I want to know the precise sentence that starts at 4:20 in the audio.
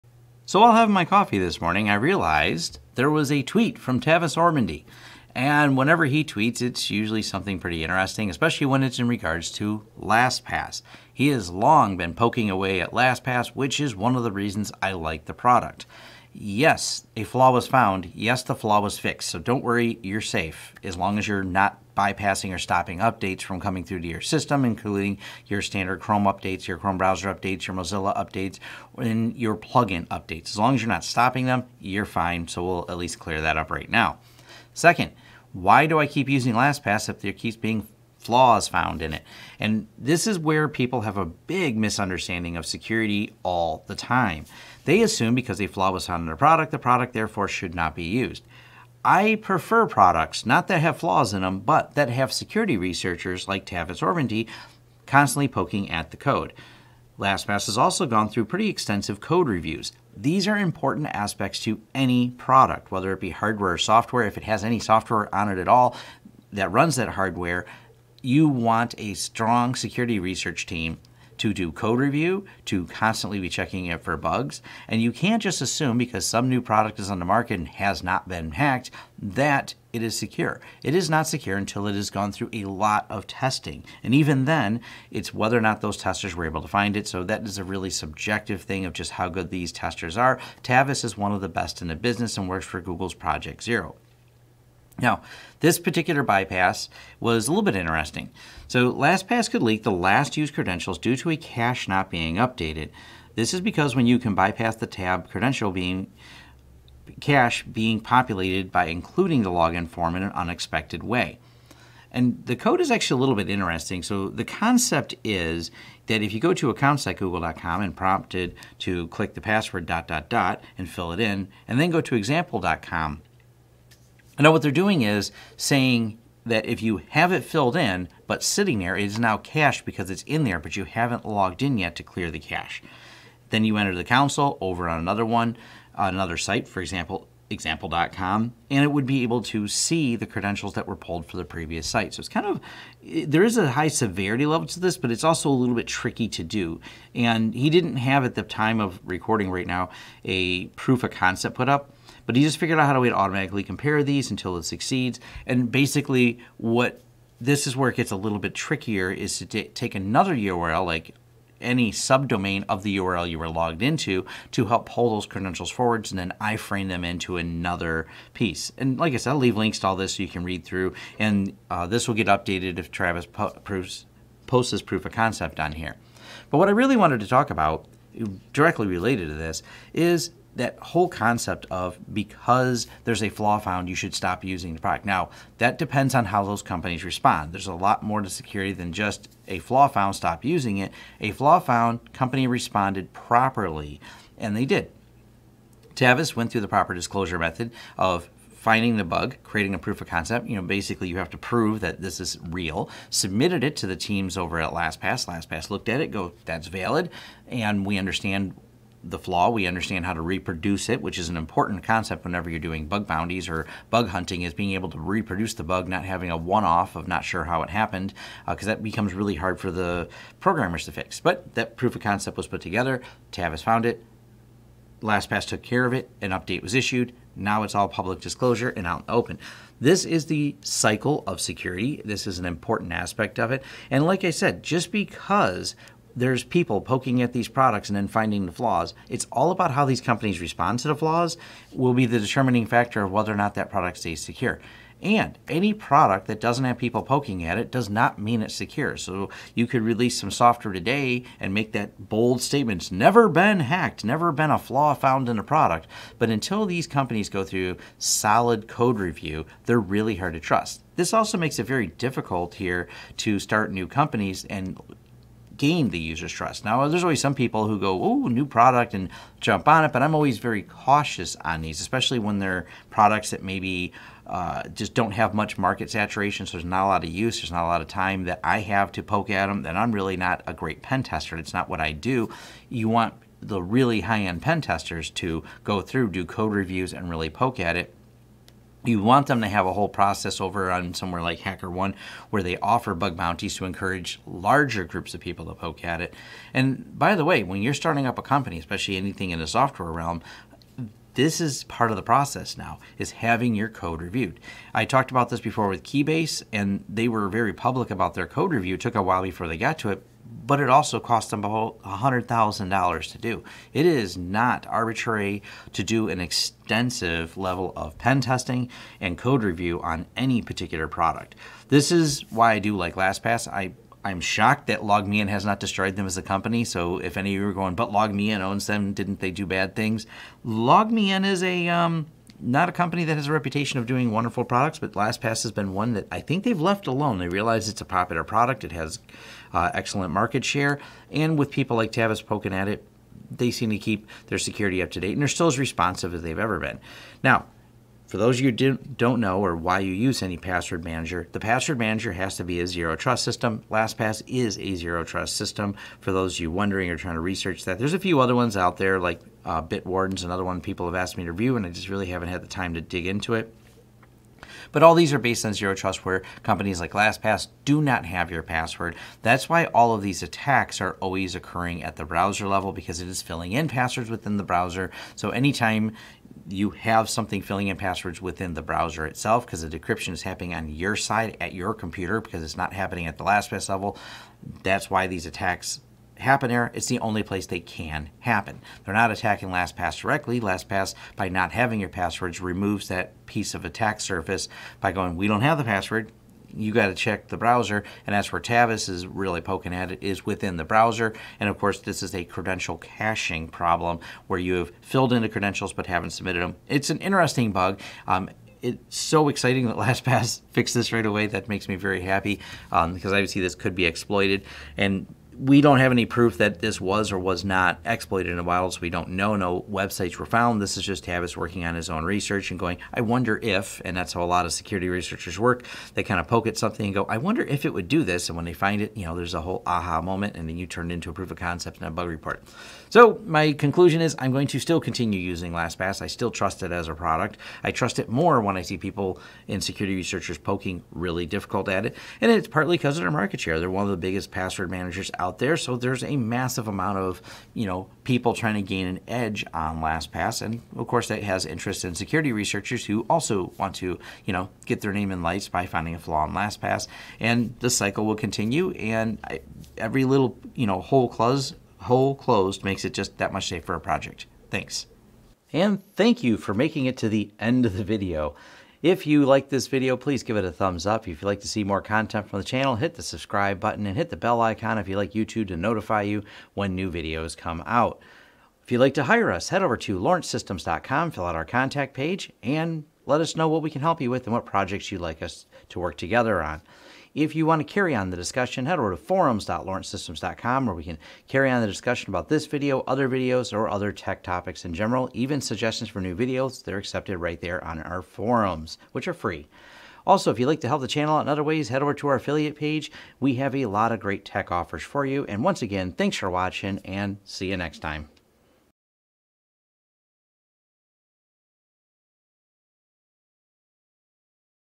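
This also makes it very difficult here to start new companies and gain the user's trust.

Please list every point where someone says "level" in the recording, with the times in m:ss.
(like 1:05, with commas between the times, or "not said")
2:24, 5:17, 6:12, 6:23.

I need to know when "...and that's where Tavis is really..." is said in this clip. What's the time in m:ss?
6:38.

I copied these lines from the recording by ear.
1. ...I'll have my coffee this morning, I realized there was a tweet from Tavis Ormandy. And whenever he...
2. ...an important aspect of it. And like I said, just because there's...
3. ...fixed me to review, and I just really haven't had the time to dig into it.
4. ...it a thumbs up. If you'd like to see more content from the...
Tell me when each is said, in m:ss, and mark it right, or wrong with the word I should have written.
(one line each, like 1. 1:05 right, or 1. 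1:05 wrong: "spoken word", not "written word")
1. 0:00 right
2. 3:52 right
3. 6:00 wrong: "asked", not "fixed"
4. 7:50 right.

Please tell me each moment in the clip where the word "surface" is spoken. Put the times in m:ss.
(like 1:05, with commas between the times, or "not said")
6:33.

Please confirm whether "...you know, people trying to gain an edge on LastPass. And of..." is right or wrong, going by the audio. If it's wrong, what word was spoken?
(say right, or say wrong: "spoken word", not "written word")
right.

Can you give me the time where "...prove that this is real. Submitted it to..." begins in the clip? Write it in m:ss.
3:21.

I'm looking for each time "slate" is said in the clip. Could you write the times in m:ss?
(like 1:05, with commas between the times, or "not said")
not said.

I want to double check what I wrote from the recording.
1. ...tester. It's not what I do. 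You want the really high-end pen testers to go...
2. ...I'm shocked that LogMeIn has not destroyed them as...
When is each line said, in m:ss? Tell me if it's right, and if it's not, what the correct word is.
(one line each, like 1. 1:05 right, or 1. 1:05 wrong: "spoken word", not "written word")
1. 4:41 right
2. 5:24 right.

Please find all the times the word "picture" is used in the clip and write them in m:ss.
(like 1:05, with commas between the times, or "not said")
not said.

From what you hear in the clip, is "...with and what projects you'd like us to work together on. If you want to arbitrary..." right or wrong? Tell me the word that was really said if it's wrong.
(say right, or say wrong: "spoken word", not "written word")
wrong: "carry", not "arbitrary".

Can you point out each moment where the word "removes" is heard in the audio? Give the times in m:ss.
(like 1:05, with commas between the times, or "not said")
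6:32.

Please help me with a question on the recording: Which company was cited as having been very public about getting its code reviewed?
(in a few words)
Keybase.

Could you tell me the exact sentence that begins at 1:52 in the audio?
And the code is actually a little bit interesting.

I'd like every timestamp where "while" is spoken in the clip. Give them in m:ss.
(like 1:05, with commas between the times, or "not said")
5:09, 6:58.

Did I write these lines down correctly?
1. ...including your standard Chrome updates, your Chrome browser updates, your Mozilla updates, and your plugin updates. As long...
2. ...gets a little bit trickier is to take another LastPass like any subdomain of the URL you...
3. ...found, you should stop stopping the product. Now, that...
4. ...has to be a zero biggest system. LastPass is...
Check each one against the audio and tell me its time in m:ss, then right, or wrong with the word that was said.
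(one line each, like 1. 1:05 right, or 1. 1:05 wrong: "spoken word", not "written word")
1. 0:24 right
2. 2:37 wrong: "URL", not "LastPass"
3. 3:03 wrong: "using", not "stopping"
4. 5:52 wrong: "trust", not "biggest".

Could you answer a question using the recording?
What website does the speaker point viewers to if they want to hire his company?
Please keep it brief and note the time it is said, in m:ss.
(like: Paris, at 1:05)
lawrencesystems.com, at 7:59.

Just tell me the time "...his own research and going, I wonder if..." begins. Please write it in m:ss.
7:01.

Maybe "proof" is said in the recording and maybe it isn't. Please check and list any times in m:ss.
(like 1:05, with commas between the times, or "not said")
2:30, 2:54, 3:19, 3:41, 6:56, 7:11.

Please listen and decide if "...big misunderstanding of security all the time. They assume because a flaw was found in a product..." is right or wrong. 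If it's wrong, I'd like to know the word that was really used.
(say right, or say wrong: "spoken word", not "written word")
right.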